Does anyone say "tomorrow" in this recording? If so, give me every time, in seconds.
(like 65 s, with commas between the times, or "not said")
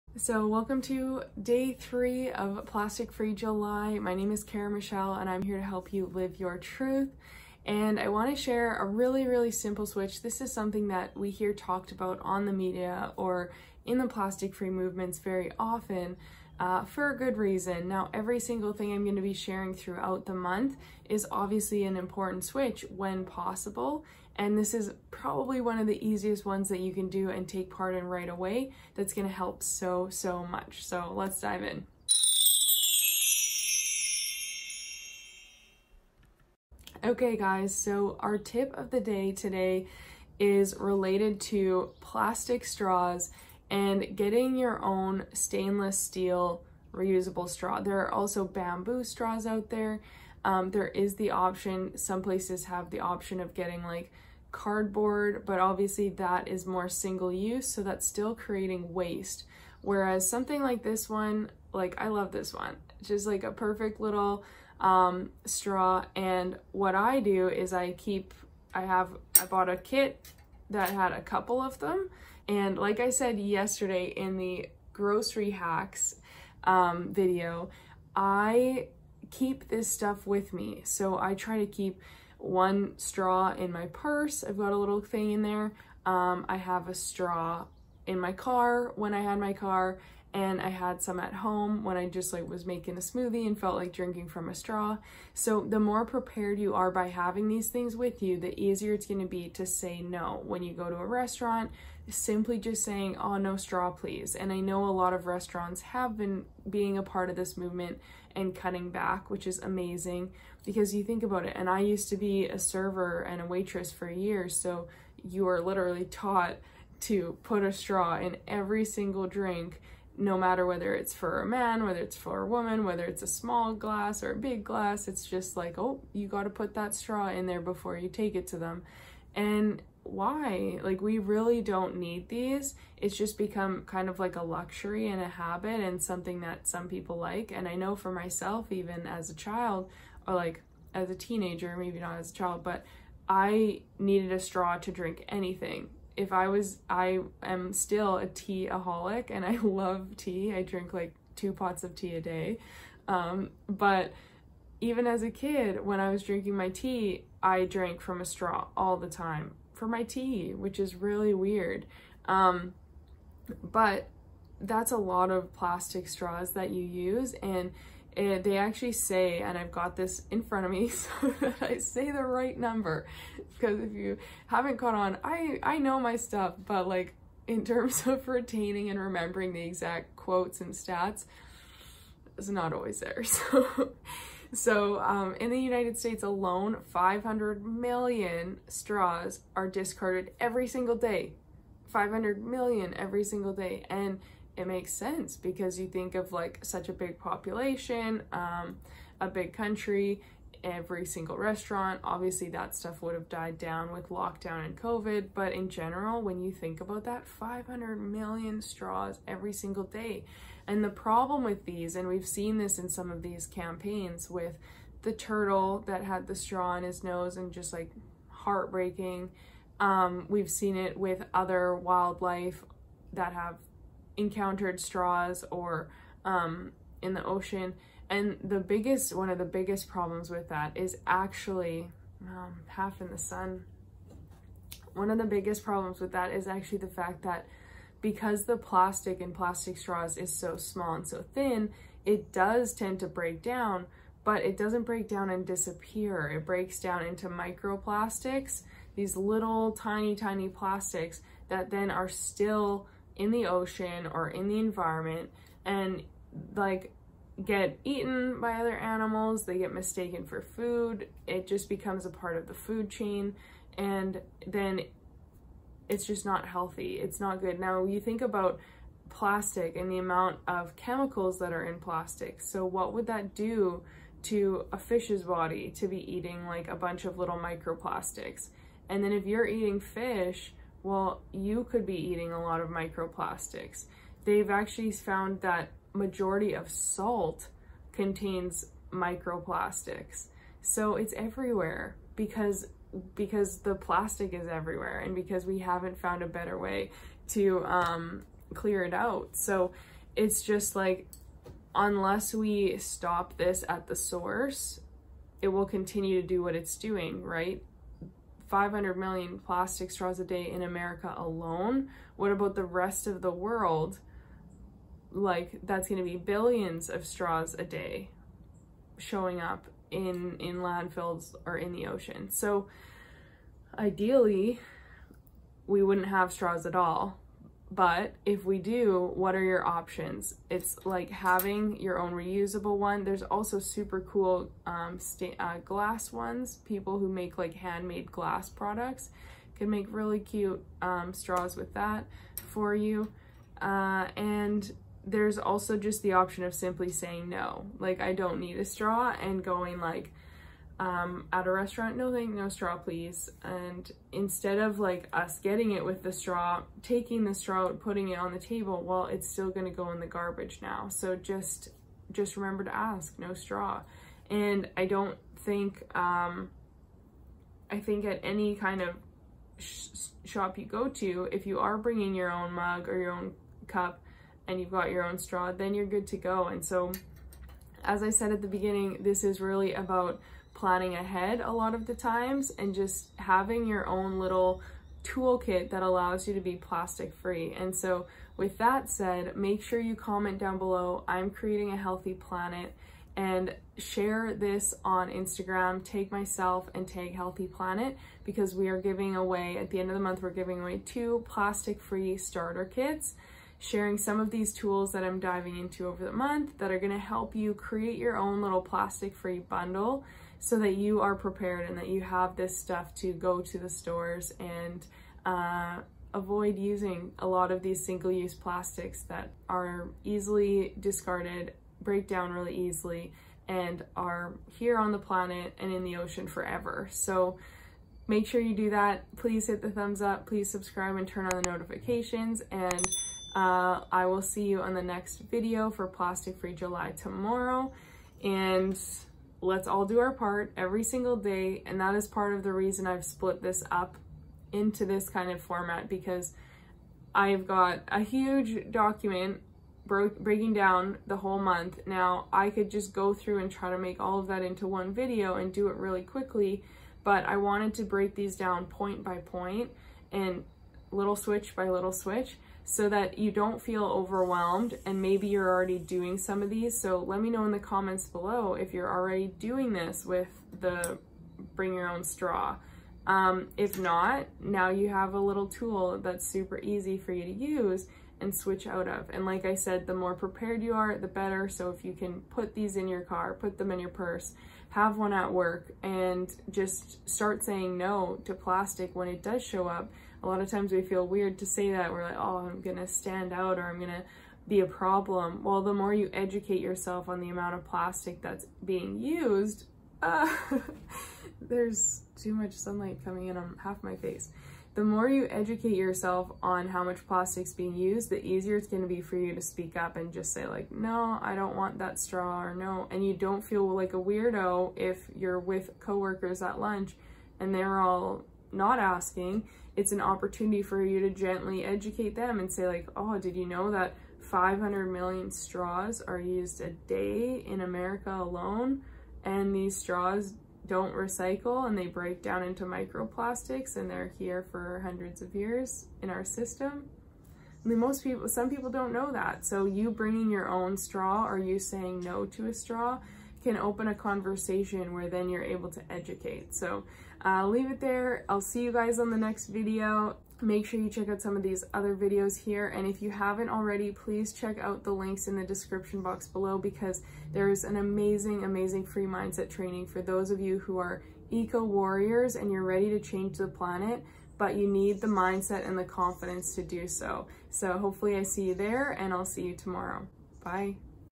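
436 s, 569 s.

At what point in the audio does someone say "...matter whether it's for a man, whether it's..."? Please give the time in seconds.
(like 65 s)
120 s.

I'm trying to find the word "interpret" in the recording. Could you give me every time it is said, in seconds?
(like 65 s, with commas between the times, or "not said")
not said.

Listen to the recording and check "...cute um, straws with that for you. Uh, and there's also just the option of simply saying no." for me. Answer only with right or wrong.
right.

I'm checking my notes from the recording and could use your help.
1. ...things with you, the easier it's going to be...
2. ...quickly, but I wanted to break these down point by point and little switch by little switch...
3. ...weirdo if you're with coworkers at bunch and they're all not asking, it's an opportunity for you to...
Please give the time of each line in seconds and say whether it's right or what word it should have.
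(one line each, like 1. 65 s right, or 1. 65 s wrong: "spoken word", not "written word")
1. 97 s right
2. 456 s right
3. 513 s wrong: "lunch", not "bunch".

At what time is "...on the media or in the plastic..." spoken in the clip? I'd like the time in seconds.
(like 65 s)
12 s.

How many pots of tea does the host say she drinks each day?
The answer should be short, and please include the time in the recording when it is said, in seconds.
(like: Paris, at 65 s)
2, at 151 s.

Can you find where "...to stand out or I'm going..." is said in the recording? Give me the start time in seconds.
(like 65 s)
492 s.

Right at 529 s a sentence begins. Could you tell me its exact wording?
And these straws don't recycle and they break down into microplastics and they're here for hundreds of years in our system.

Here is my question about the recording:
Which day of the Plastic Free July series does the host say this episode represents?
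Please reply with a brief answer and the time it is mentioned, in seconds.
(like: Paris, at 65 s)
Day 3, at 1 s.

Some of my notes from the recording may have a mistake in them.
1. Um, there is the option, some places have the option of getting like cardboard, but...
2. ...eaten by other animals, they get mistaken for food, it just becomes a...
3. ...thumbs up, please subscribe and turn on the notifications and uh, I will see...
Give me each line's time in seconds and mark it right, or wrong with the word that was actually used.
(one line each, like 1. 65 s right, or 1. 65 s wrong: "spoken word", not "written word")
1. 50 s right
2. 257 s right
3. 429 s right.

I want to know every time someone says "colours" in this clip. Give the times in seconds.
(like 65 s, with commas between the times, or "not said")
not said.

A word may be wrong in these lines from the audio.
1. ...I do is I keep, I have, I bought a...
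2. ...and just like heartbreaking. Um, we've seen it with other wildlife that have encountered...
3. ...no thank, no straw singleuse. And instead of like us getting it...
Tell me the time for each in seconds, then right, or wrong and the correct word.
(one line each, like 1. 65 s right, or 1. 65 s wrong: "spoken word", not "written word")
1. 66 s right
2. 217 s right
3. 351 s wrong: "please", not "singleuse".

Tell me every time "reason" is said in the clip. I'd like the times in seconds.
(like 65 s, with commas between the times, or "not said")
17 s, 442 s.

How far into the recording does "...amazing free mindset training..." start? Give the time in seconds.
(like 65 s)
558 s.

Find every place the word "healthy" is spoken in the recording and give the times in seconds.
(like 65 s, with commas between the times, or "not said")
266 s, 391 s, 397 s.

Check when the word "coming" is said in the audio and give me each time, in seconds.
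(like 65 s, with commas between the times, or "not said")
503 s.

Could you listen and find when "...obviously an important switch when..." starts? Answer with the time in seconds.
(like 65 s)
21 s.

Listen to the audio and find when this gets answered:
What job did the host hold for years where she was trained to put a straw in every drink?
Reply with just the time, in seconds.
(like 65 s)
112 s.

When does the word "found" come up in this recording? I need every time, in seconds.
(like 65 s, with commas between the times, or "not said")
284 s, 295 s.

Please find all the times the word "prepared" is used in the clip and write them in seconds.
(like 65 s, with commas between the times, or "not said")
96 s, 411 s, 480 s.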